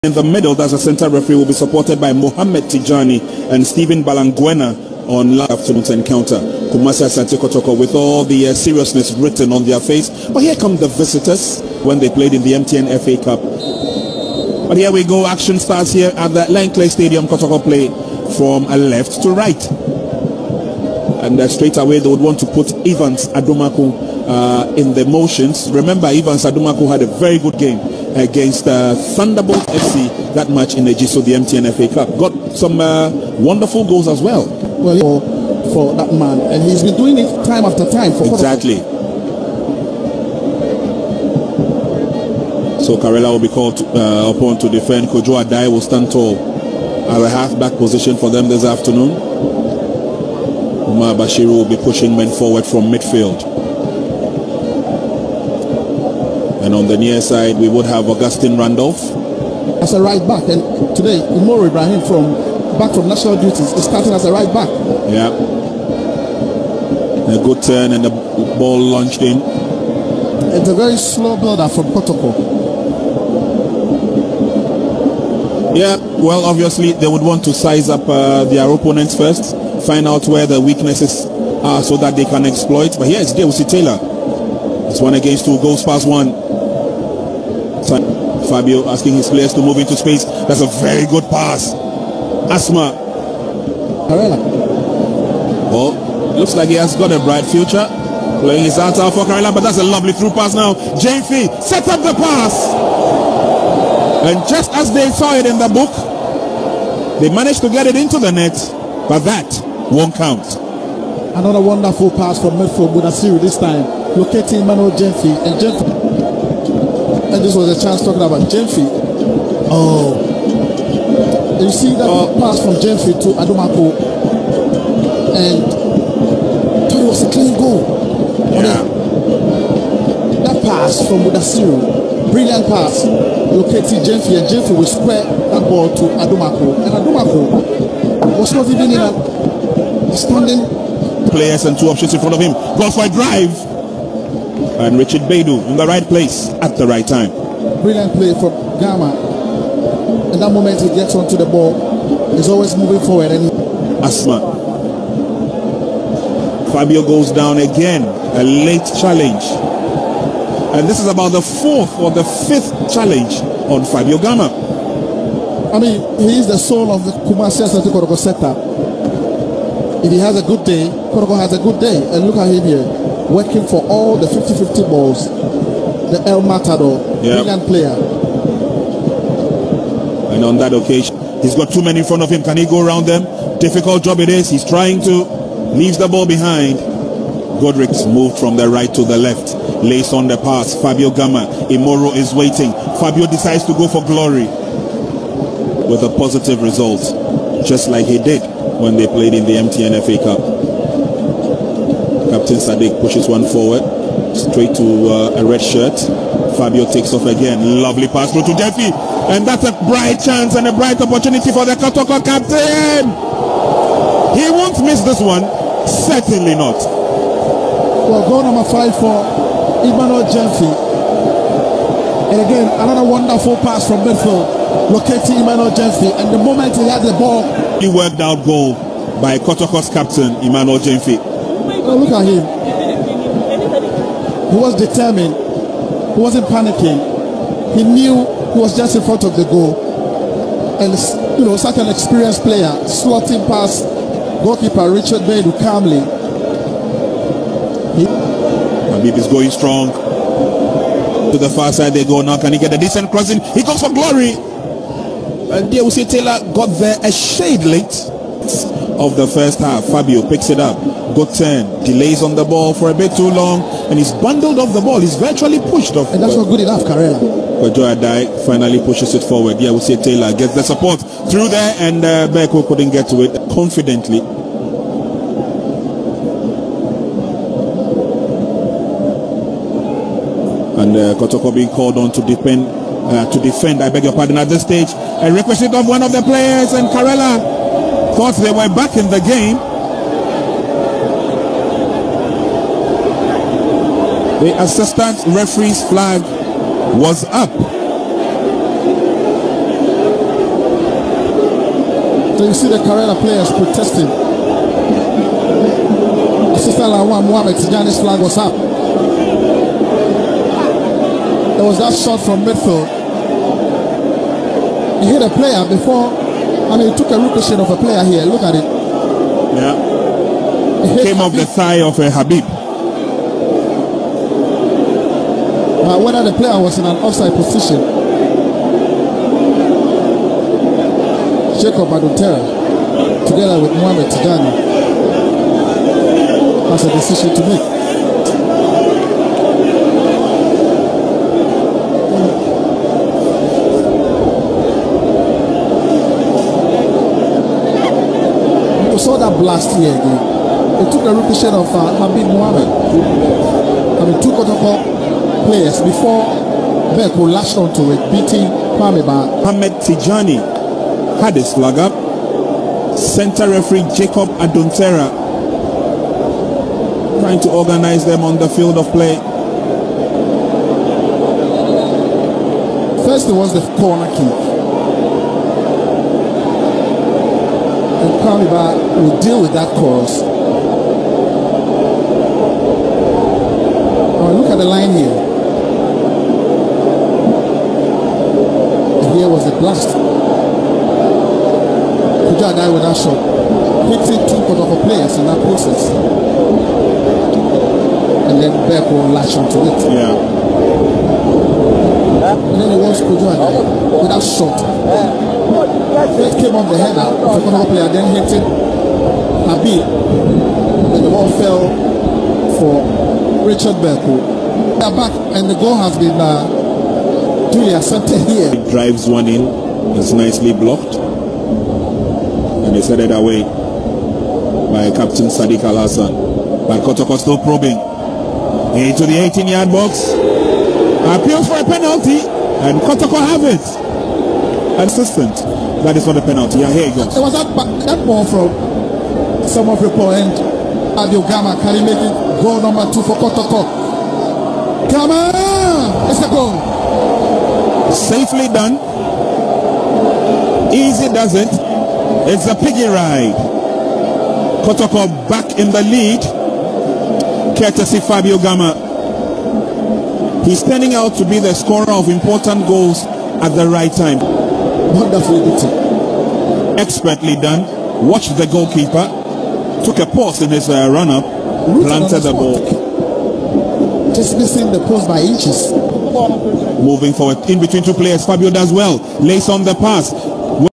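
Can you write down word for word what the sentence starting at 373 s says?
First, it was the corner kick.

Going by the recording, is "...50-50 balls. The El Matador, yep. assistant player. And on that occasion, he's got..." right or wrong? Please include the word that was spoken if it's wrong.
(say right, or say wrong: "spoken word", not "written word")
wrong: "brilliant", not "assistant".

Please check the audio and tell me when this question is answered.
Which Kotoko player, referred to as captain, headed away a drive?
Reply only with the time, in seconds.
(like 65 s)
424 s.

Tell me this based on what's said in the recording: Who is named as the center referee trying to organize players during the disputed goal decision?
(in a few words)
Jacob Adontera.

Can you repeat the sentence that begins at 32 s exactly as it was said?
Got some uh, wonderful goals as well.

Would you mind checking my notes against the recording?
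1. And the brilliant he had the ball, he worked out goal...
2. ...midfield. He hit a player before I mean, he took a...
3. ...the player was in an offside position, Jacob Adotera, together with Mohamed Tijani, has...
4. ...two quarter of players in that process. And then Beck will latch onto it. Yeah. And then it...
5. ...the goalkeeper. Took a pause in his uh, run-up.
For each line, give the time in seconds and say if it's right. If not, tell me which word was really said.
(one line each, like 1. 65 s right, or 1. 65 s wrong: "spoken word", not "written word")
1. 226 s wrong: "moment", not "brilliant"
2. 312 s right
3. 326 s right
4. 394 s right
5. 468 s right.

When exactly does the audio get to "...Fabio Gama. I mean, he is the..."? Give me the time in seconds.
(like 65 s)
163 s.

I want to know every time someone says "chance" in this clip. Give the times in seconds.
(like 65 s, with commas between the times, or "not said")
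117 s, 210 s.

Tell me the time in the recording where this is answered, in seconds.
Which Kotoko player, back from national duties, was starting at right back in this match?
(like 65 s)
61 s.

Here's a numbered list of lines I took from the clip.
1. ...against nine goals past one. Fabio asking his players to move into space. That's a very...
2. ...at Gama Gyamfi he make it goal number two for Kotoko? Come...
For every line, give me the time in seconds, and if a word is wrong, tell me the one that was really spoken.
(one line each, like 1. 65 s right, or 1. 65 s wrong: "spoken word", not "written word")
1. 85 s wrong: "two", not "nine"
2. 440 s wrong: "Can", not "Gyamfi".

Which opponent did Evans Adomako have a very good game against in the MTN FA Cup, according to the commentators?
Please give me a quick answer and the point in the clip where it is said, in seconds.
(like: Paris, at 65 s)
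Thunderbolt FC, at 29 s.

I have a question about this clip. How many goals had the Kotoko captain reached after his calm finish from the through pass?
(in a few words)
5.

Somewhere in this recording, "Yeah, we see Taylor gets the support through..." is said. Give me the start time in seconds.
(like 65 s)
269 s.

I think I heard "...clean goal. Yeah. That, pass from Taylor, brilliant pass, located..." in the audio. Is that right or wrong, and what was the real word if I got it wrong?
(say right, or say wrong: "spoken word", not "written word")
wrong: "Mudasiru", not "Taylor".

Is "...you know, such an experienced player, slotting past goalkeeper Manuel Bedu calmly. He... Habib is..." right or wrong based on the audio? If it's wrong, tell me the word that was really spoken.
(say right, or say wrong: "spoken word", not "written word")
wrong: "Richard", not "Manuel".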